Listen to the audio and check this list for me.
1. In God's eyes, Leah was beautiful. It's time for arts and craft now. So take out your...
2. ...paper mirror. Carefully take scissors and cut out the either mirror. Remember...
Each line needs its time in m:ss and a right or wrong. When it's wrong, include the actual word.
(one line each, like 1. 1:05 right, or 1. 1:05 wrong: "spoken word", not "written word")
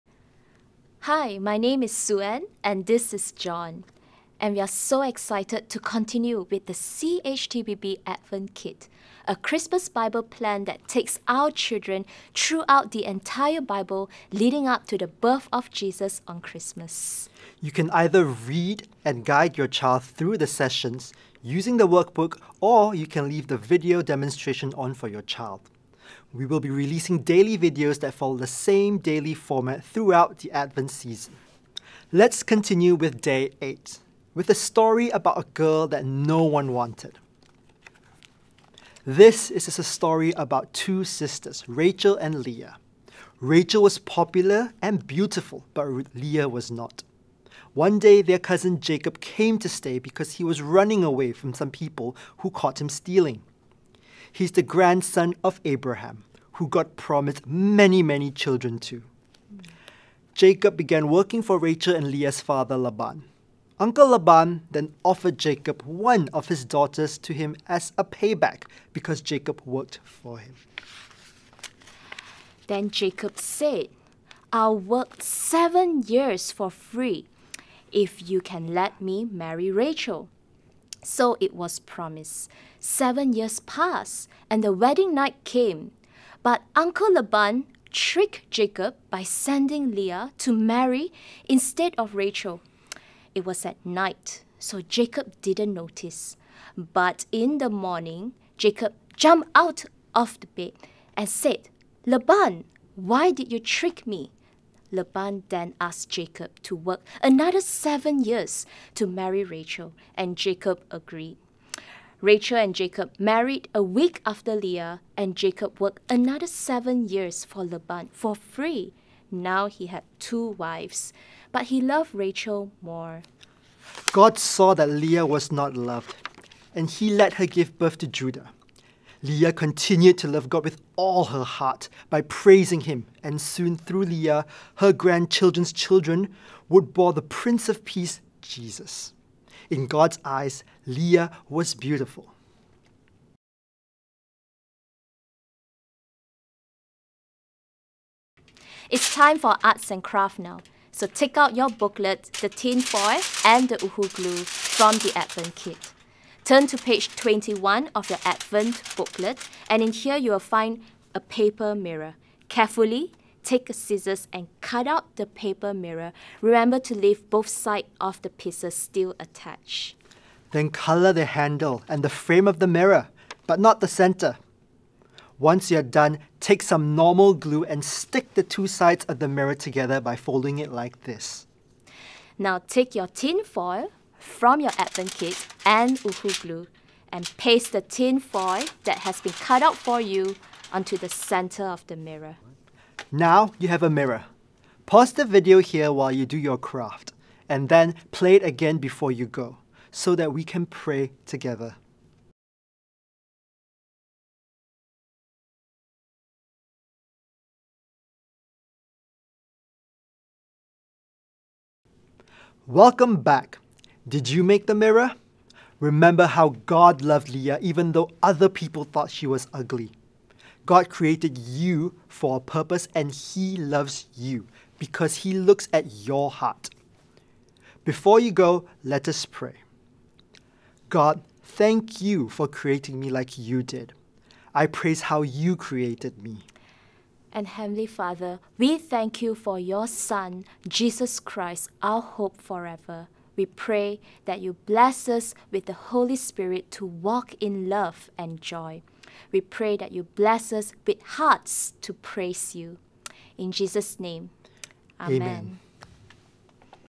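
1. 2:19 right
2. 2:41 wrong: "paper", not "either".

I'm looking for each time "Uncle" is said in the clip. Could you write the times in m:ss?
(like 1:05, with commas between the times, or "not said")
1:03, 1:26.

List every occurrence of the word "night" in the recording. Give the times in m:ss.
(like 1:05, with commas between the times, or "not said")
1:25, 1:33.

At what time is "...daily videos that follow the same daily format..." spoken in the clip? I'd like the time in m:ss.
0:27.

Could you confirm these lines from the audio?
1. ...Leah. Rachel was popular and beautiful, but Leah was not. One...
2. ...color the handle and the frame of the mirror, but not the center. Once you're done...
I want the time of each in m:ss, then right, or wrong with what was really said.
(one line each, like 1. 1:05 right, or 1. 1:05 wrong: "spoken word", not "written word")
1. 0:42 right
2. 2:50 right.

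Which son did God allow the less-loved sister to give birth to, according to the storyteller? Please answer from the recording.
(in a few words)
Judah.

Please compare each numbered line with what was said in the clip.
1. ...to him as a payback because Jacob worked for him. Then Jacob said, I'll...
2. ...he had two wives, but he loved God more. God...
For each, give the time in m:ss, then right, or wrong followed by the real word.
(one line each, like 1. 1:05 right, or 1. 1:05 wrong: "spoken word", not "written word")
1. 1:07 right
2. 1:59 wrong: "Rachel", not "God".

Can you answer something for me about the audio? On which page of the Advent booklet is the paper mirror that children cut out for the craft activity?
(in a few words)
21.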